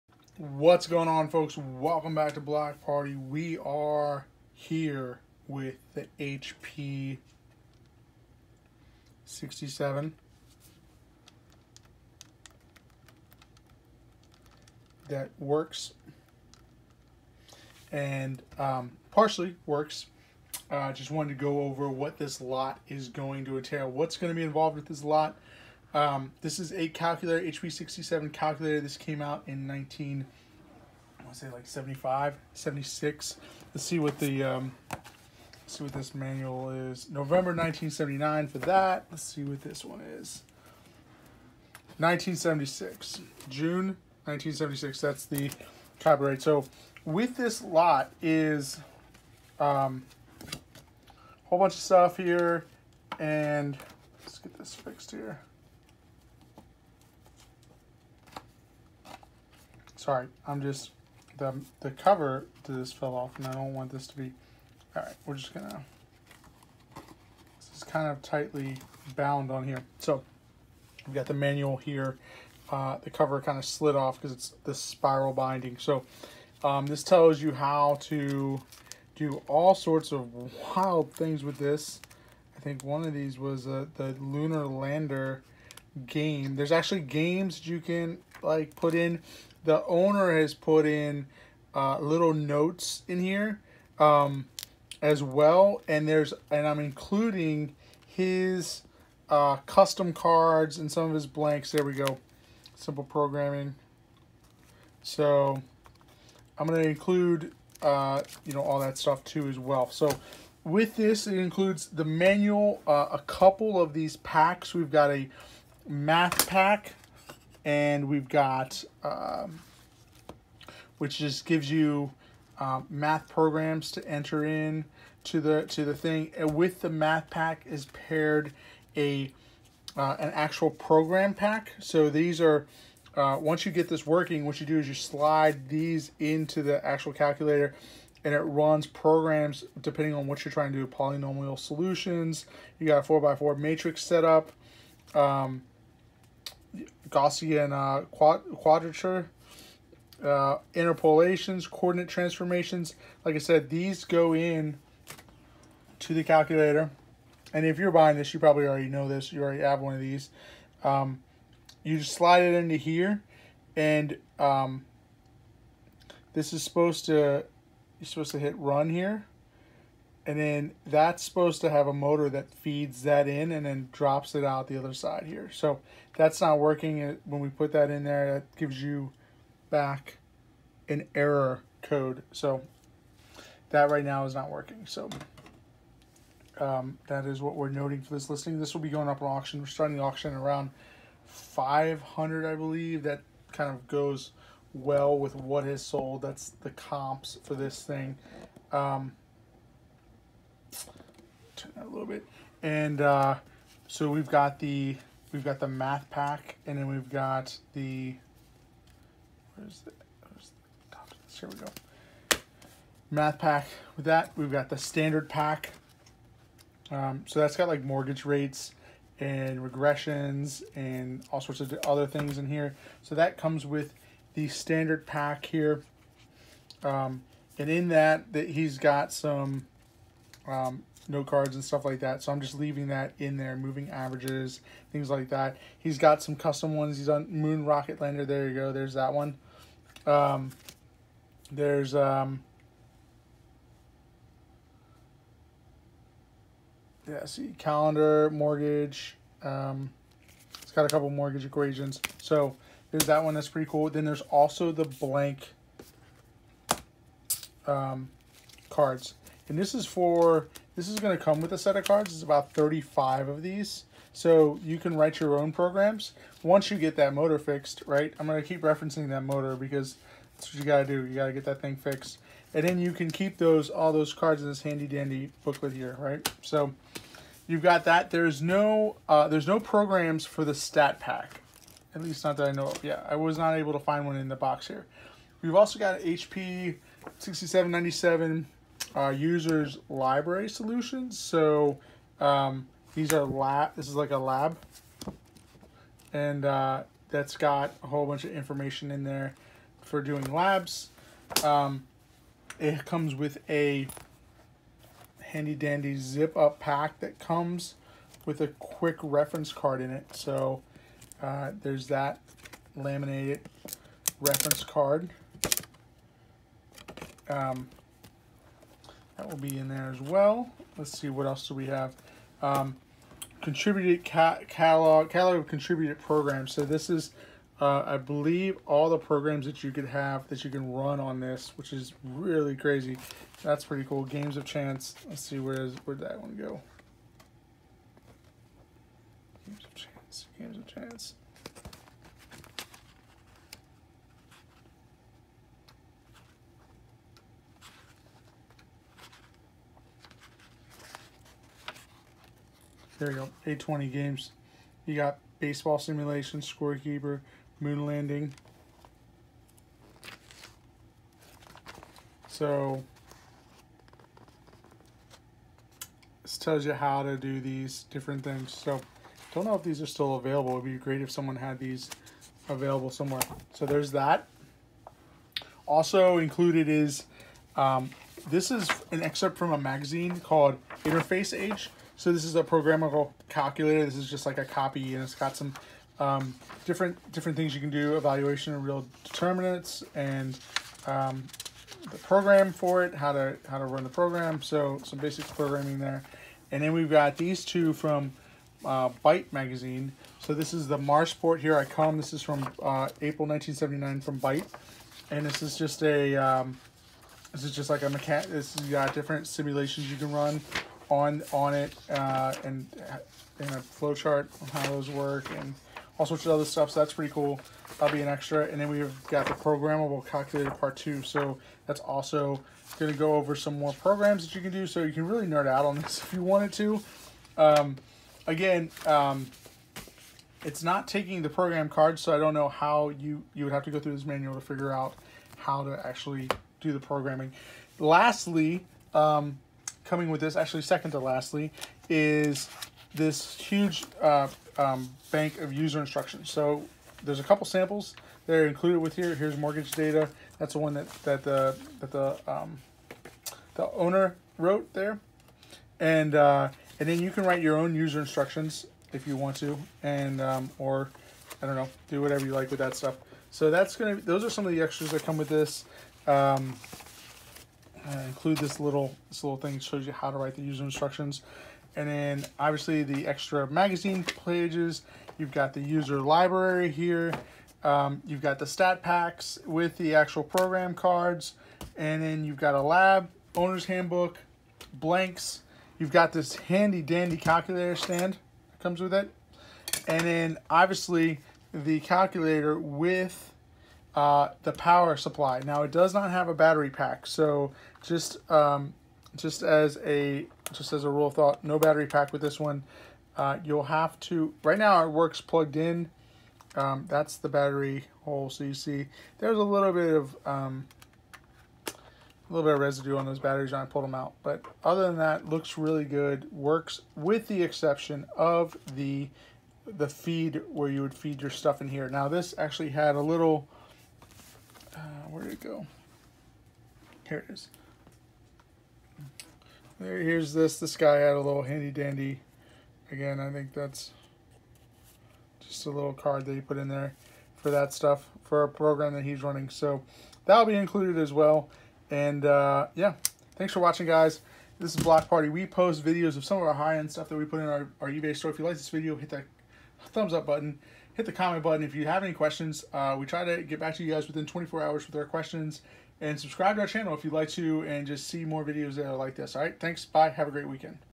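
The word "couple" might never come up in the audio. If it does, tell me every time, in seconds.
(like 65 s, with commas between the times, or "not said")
113 s, 250 s, 447 s.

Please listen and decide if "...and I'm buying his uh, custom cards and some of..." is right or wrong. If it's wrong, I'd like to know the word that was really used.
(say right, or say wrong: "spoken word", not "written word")
wrong: "including", not "buying".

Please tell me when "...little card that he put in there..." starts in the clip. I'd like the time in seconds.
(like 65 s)
535 s.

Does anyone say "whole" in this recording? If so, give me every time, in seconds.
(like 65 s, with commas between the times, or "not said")
51 s, 297 s.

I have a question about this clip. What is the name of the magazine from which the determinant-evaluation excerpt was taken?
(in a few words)
Interface Age.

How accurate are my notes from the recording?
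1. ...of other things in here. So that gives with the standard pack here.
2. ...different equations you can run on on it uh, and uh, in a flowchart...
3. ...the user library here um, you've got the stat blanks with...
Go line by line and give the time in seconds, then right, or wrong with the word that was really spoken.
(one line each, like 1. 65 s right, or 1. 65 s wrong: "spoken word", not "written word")
1. 221 s wrong: "comes", not "gives"
2. 408 s wrong: "simulations", not "equations"
3. 475 s wrong: "packs", not "blanks".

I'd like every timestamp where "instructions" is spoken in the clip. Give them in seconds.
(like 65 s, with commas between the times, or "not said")
445 s, 457 s, 470 s.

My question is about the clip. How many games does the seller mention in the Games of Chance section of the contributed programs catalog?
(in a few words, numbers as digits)
820.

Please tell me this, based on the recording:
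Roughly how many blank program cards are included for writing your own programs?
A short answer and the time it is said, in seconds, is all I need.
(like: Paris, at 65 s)
35, at 262 s.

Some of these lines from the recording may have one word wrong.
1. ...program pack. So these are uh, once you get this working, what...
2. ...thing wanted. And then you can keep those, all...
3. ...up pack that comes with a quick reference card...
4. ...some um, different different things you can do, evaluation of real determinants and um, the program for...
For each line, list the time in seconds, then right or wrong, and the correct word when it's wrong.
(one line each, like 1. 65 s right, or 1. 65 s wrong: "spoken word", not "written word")
1. 130 s right
2. 271 s wrong: "fixed", not "wanted"
3. 306 s right
4. 385 s right.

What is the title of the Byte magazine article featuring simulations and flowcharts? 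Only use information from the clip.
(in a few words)
Marsport Here I Come.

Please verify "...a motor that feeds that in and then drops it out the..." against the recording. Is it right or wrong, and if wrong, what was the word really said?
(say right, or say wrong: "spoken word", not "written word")
right.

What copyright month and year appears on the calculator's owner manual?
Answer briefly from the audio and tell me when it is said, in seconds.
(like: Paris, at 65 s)
June 1976, at 43 s.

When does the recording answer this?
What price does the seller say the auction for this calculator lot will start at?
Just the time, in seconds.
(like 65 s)
191 s.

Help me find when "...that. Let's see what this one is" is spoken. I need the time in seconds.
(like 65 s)
38 s.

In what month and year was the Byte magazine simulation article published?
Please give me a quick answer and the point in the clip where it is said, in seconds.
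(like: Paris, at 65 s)
April 1979, at 403 s.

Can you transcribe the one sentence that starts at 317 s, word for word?
Um, that will be in there as well.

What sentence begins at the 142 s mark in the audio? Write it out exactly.
You got a four by four matrix setup.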